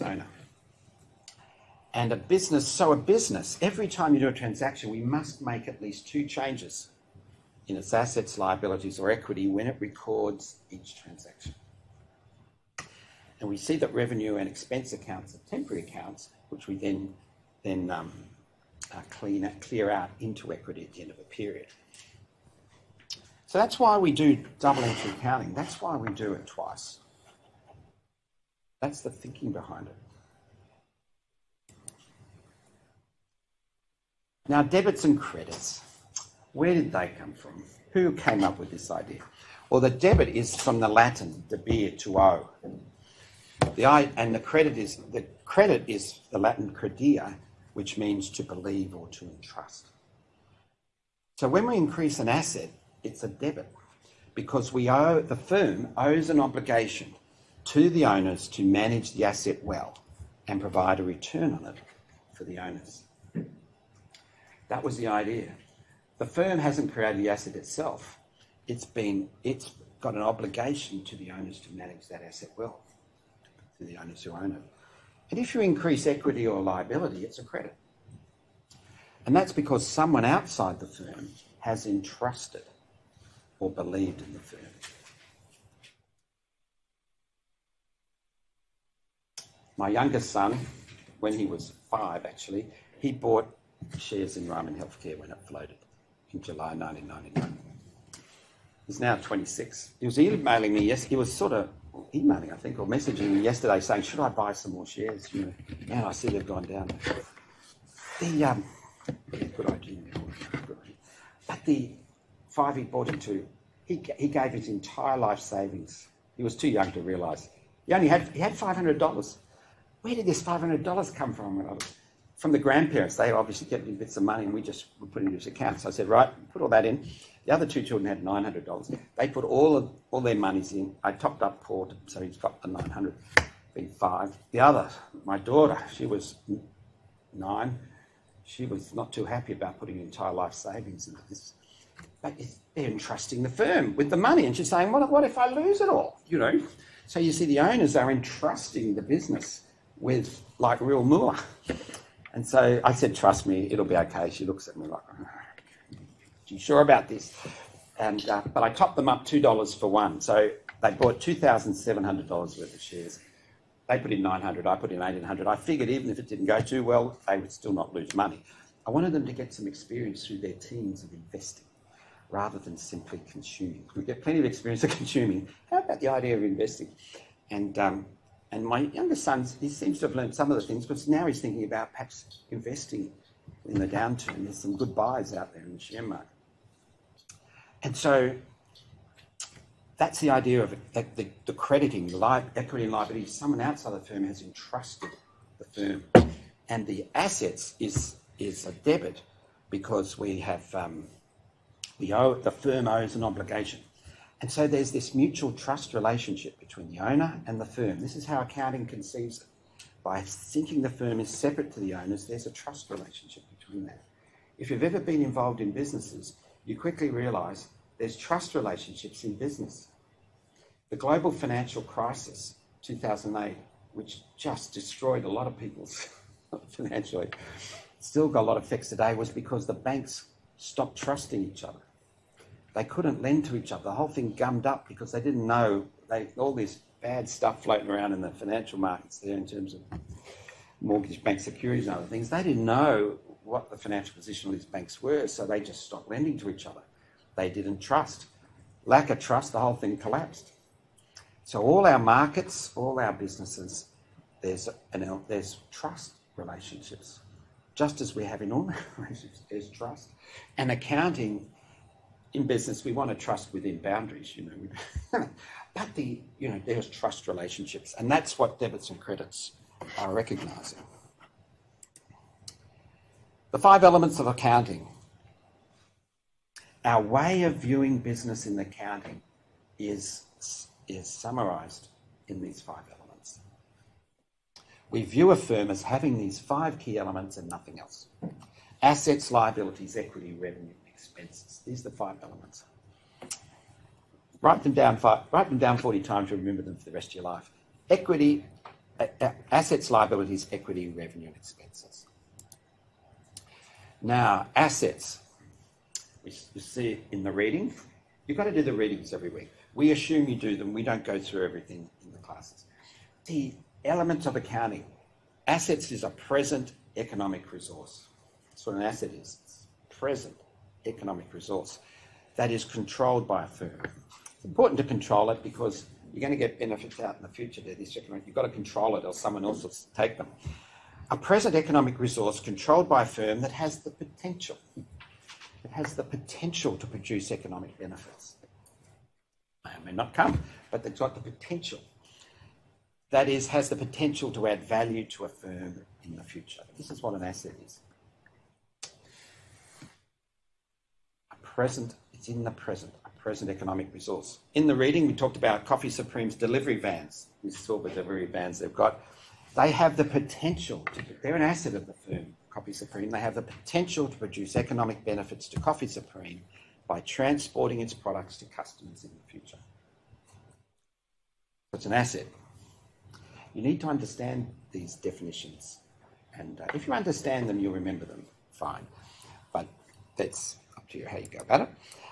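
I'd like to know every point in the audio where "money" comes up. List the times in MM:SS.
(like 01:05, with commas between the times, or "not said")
02:04, 02:24, 02:48.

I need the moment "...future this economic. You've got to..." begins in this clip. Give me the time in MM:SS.
05:27.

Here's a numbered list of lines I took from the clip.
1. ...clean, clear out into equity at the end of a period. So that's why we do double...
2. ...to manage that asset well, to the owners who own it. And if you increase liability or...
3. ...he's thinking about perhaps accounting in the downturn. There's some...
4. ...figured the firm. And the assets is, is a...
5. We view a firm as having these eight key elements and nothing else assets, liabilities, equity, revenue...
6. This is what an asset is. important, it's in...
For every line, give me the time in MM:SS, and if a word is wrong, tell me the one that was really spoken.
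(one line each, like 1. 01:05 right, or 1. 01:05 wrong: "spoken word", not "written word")
1. 00:19 right
2. 01:11 wrong: "equity", not "liability"
3. 03:01 wrong: "investing", not "accounting"
4. 03:14 wrong: "entrusted", not "figured"
5. 04:44 wrong: "five", not "eight"
6. 05:46 wrong: "present", not "important".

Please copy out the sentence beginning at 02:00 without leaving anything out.
Where did this $500 come from?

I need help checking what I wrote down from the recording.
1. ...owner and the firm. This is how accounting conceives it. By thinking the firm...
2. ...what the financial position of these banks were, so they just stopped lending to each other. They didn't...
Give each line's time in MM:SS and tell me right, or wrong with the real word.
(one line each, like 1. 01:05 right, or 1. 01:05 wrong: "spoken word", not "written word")
1. 03:26 right
2. 04:03 right.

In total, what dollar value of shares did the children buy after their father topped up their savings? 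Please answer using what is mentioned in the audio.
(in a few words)
$2,700.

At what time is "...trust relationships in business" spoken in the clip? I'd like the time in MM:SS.
03:38.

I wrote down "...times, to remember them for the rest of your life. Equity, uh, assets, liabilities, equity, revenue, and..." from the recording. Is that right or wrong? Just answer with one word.
right.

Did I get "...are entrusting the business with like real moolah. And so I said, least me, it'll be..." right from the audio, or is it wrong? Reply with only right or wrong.
wrong.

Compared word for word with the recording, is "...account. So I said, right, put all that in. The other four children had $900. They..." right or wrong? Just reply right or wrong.
wrong.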